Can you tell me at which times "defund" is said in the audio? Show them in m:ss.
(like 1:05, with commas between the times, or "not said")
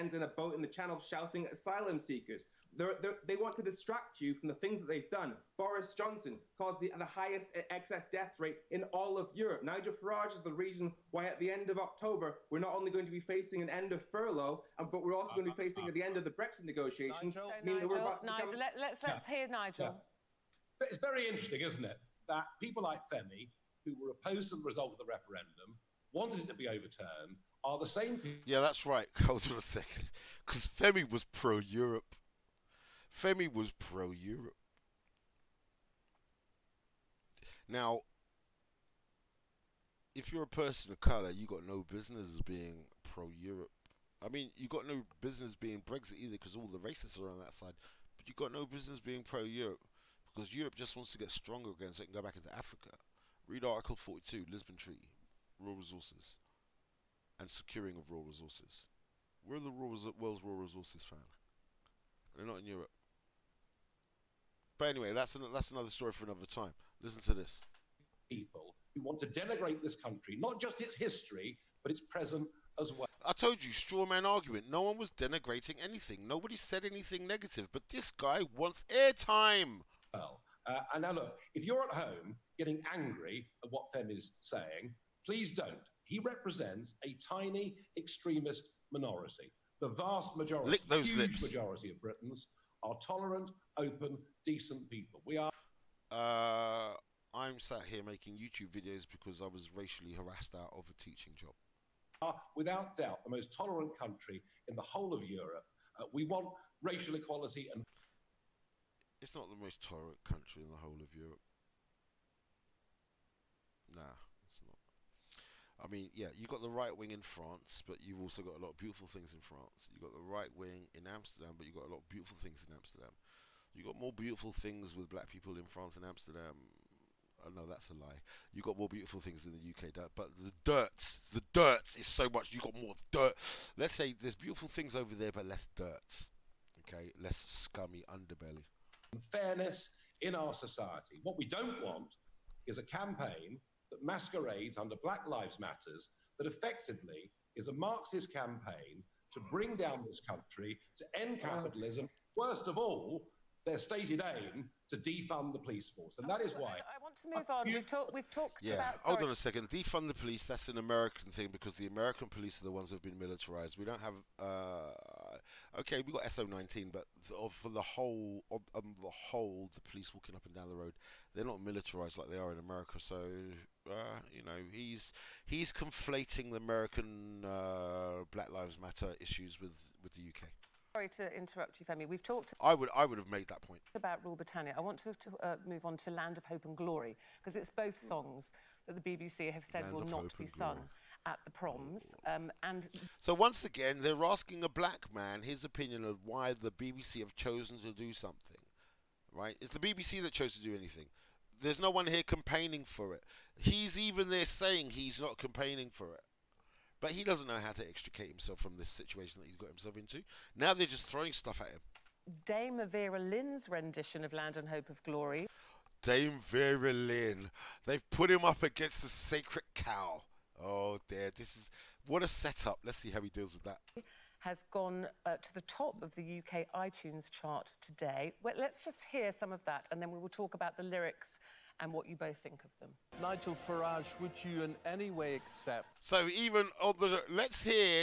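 2:34, 2:39.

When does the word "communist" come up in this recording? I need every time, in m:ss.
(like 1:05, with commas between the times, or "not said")
not said.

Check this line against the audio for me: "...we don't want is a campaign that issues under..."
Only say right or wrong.
wrong.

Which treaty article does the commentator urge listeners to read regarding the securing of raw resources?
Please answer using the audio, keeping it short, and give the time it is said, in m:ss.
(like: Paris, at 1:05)
Article 42, at 0:53.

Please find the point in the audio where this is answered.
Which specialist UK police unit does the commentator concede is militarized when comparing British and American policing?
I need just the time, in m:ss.
2:46.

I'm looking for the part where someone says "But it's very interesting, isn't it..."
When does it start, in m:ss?
0:20.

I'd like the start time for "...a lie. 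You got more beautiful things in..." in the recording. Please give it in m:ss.
2:07.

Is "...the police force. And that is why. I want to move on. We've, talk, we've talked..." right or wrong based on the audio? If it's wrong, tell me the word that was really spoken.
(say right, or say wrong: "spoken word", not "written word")
right.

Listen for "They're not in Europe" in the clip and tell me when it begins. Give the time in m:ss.
1:02.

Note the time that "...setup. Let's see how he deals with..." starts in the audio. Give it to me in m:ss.
3:42.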